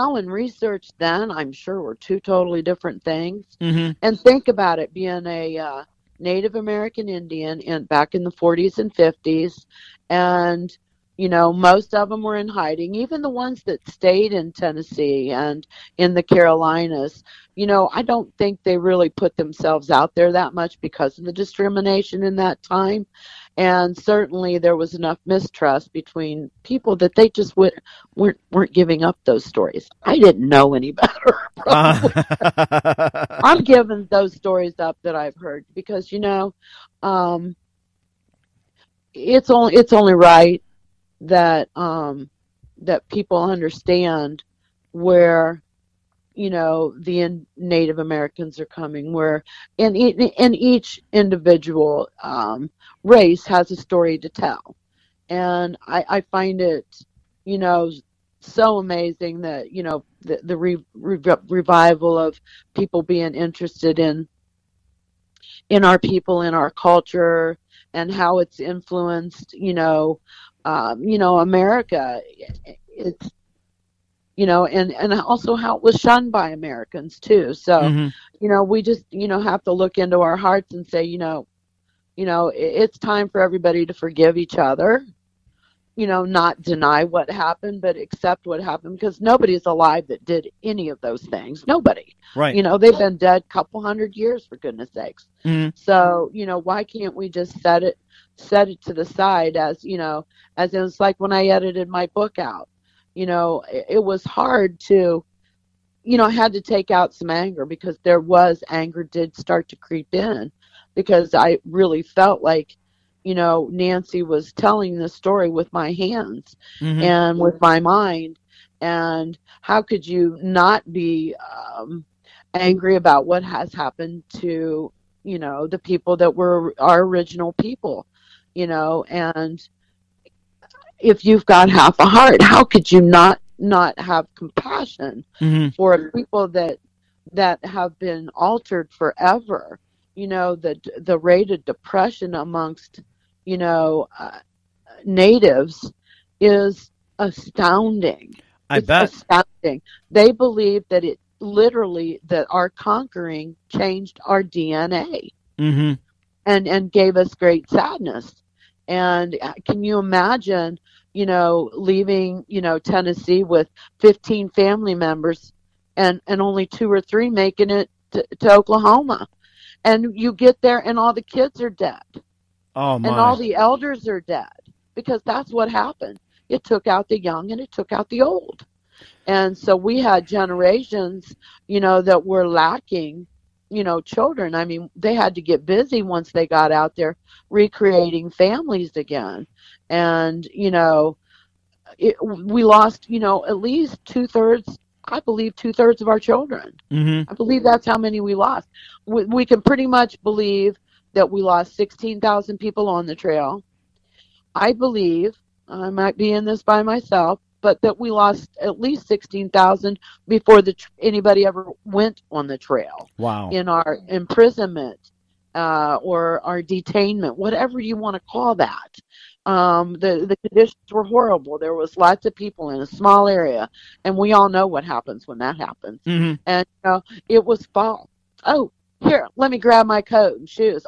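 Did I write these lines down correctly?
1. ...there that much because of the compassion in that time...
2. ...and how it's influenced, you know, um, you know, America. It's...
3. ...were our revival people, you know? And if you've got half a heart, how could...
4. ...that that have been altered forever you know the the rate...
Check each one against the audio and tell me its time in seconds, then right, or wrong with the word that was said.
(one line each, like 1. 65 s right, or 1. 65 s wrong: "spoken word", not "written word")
1. 20 s wrong: "discrimination", not "compassion"
2. 67 s right
3. 126 s wrong: "original", not "revival"
4. 136 s right.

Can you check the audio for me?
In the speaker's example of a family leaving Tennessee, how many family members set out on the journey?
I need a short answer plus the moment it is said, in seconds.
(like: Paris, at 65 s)
15, at 164 s.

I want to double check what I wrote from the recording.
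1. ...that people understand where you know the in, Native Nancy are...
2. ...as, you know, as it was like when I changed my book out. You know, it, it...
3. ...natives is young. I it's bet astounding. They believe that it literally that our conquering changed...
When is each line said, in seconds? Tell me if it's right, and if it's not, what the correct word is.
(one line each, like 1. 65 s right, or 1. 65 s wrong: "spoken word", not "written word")
1. 42 s wrong: "Americans", not "Nancy"
2. 99 s wrong: "edited", not "changed"
3. 145 s wrong: "astounding", not "young".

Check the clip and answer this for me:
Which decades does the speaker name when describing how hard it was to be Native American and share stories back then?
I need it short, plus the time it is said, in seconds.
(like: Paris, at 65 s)
40s and 50s, at 8 s.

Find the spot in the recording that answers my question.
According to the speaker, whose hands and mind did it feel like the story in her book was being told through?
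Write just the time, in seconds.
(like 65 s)
113 s.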